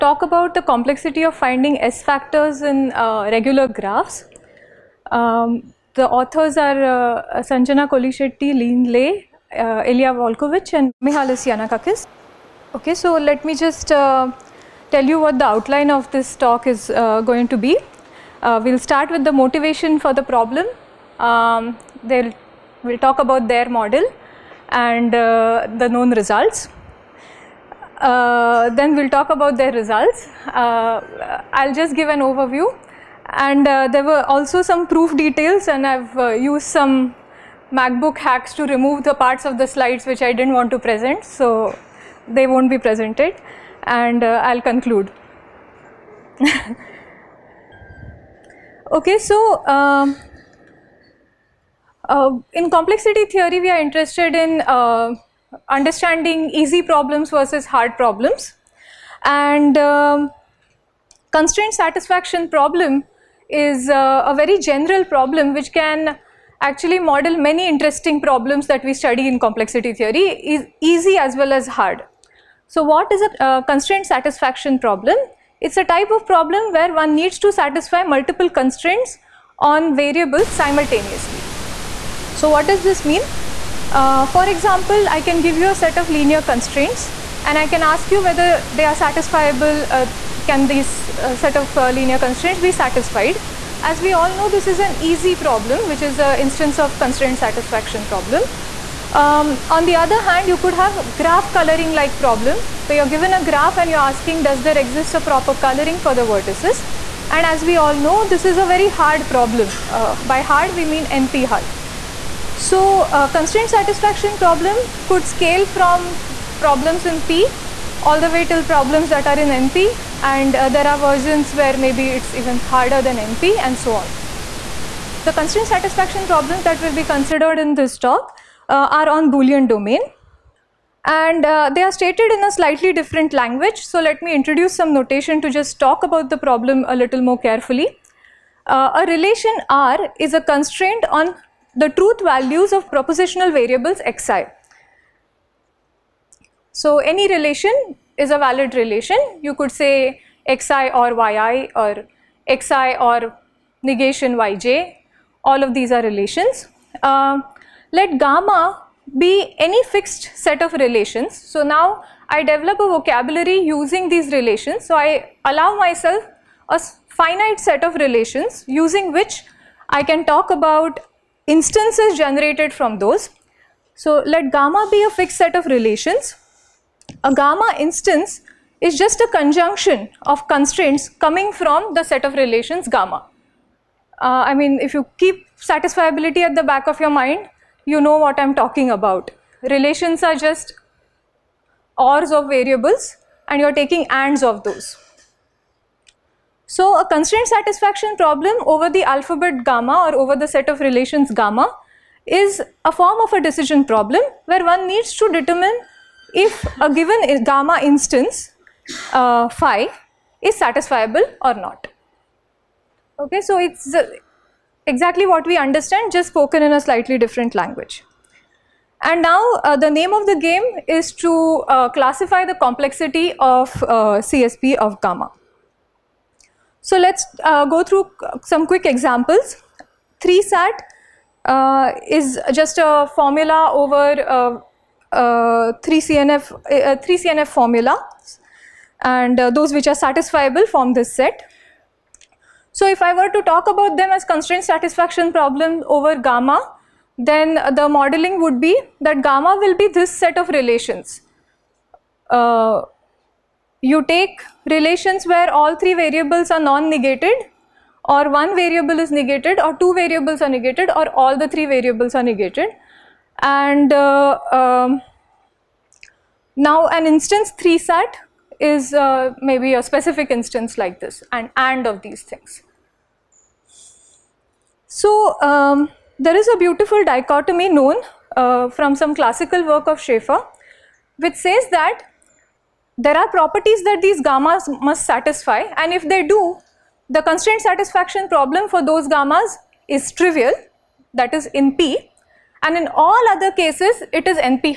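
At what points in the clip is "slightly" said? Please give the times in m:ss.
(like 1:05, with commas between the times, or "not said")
2:12, 3:36.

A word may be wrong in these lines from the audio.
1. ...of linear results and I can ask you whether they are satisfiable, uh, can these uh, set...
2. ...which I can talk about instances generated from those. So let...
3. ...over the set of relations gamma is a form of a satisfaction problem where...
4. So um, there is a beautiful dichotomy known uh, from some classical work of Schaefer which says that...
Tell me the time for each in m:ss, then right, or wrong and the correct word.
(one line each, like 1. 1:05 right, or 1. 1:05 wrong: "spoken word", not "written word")
1. 1:25 wrong: "constraints", not "results"
2. 2:49 right
3. 3:20 wrong: "decision", not "satisfaction"
4. 4:34 right.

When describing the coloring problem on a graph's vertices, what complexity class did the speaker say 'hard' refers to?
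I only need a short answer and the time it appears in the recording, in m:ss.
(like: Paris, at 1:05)
NP hard, at 1:51.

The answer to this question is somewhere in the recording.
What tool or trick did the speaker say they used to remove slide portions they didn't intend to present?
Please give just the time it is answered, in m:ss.
0:37.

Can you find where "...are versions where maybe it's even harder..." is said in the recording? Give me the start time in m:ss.
2:00.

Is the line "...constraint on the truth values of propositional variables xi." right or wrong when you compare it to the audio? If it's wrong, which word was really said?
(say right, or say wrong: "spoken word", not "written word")
right.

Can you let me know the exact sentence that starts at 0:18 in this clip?
Uh, we'll start with the motivation for the problem.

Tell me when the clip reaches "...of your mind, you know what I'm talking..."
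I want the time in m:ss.
3:06.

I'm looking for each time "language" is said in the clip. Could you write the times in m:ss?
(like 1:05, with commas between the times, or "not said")
2:13, 3:37.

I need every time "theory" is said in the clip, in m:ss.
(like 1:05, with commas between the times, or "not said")
0:53, 1:09.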